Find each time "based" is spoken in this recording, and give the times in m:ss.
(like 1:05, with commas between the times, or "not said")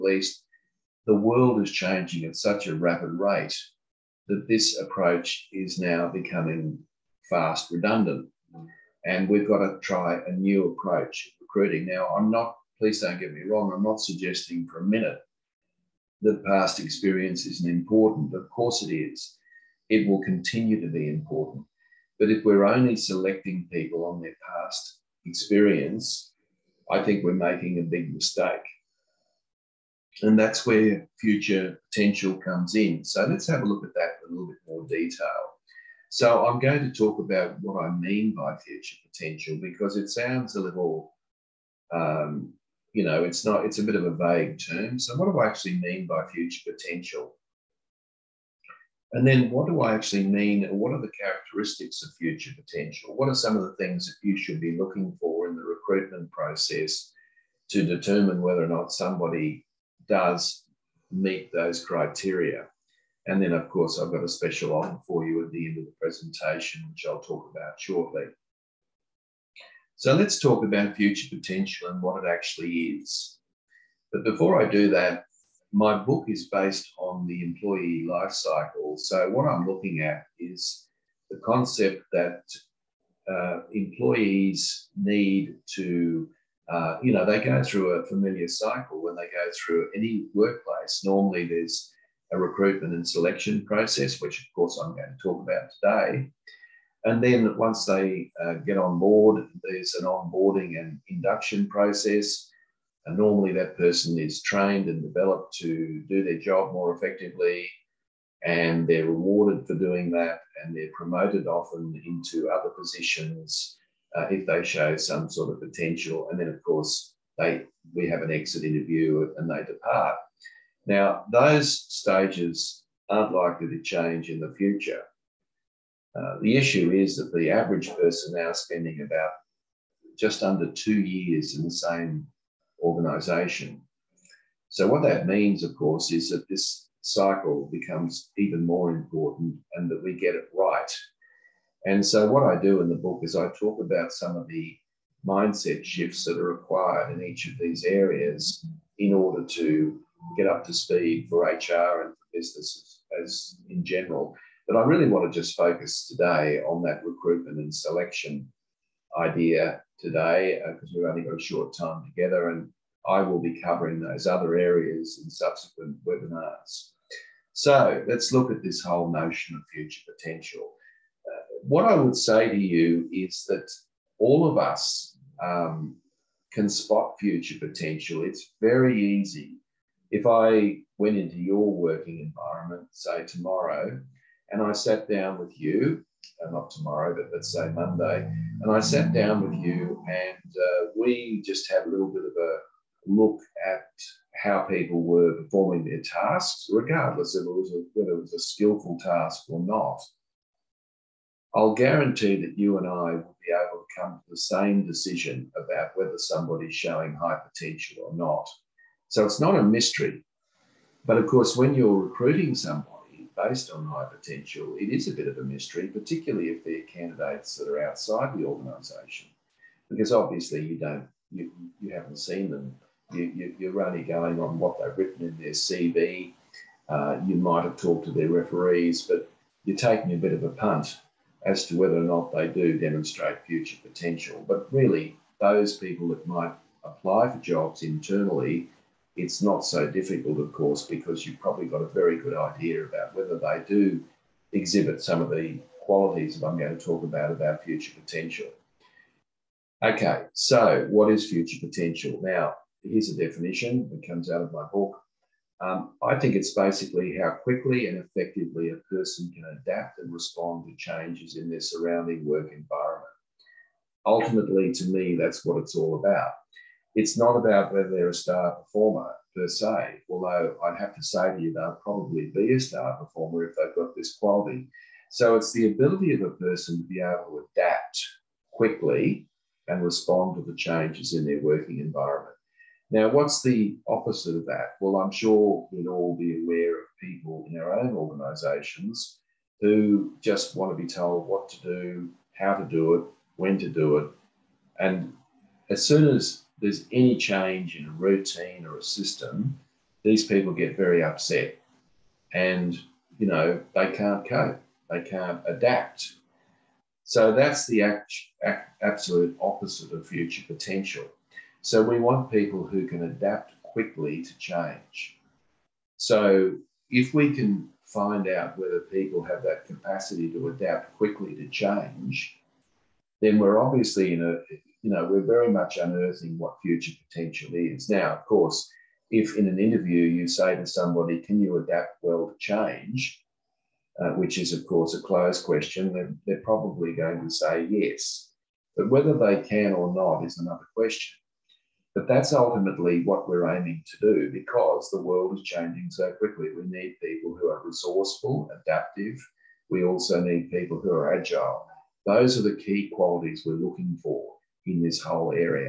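1:16, 3:33.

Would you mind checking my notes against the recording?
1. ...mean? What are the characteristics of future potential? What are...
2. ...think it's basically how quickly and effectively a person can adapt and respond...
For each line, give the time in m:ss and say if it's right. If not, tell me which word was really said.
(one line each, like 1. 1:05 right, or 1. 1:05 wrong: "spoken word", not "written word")
1. 0:50 right
2. 4:16 right.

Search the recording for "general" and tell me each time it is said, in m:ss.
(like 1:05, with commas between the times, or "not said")
2:33.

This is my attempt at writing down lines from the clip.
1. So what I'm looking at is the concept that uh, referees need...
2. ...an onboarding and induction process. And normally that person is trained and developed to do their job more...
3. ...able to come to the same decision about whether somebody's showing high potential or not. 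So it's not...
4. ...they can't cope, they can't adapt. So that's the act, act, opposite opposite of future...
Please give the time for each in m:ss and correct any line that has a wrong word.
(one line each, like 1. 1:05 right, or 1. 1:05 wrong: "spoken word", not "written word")
1. 1:18 wrong: "employees", not "referees"
2. 1:39 right
3. 3:23 right
4. 5:03 wrong: "absolute", not "opposite".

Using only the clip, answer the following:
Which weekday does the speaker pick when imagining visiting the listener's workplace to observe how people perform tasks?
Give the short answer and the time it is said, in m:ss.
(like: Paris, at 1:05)
Monday, at 3:07.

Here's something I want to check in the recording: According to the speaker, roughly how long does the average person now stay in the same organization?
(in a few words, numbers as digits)
Just under 2 years.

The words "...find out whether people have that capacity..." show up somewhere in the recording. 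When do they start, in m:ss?
5:17.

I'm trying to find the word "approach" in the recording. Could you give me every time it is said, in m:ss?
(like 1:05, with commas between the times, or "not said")
0:04, 0:10.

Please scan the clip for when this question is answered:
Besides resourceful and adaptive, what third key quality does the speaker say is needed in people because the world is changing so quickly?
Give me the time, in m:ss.
5:51.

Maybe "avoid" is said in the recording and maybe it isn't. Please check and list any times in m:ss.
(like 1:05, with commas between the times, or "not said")
not said.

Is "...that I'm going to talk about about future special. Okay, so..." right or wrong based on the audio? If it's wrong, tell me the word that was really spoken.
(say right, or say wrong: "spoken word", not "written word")
wrong: "potential", not "special".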